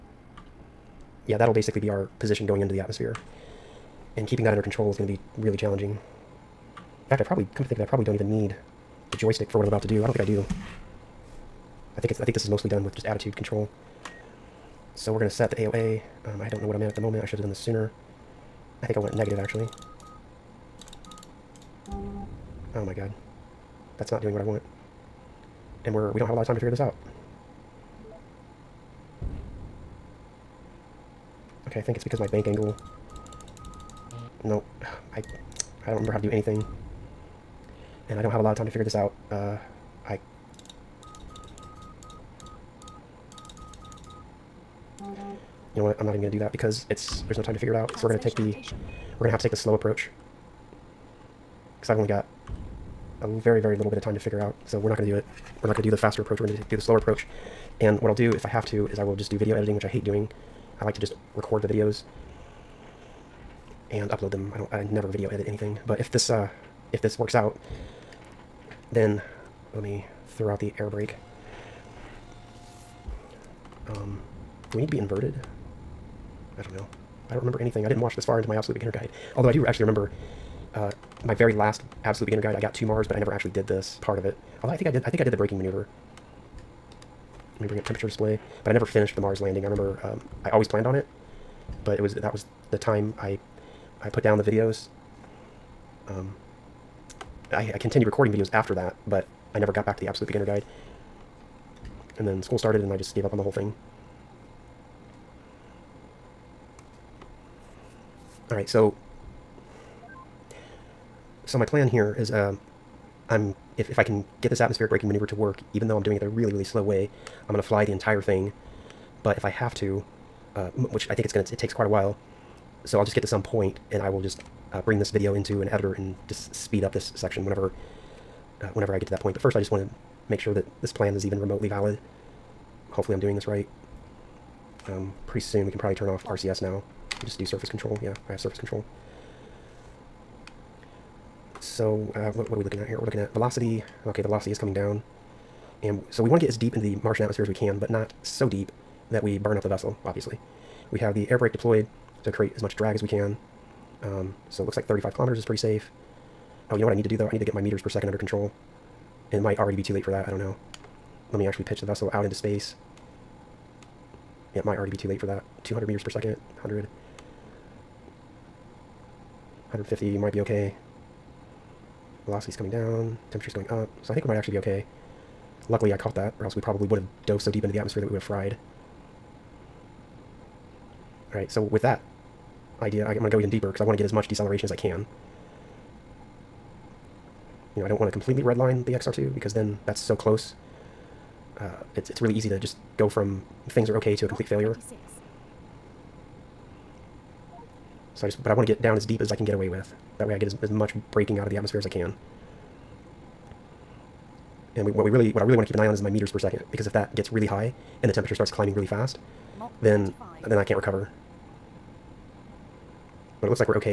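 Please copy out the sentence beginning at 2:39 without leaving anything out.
And it might already be too late for that.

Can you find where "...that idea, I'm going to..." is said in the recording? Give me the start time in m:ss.
3:01.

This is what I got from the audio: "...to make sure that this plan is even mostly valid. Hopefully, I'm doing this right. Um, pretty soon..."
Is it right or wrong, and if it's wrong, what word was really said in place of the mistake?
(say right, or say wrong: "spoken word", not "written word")
wrong: "remotely", not "mostly".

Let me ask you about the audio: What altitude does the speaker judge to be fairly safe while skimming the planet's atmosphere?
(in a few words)
35 kilometers.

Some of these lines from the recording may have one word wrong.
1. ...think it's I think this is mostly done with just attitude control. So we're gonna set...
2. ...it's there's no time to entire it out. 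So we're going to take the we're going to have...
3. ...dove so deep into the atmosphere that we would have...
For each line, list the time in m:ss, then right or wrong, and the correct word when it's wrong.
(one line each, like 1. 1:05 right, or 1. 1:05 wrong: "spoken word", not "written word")
1. 0:11 right
2. 0:46 wrong: "figure", not "entire"
3. 2:57 right.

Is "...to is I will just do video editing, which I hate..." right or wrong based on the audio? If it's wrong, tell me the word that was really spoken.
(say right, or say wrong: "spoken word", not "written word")
right.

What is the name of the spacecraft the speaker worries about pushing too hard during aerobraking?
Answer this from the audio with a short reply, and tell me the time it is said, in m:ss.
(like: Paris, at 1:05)
XR2, at 3:08.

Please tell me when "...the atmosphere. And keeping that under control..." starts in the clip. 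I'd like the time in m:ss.
0:02.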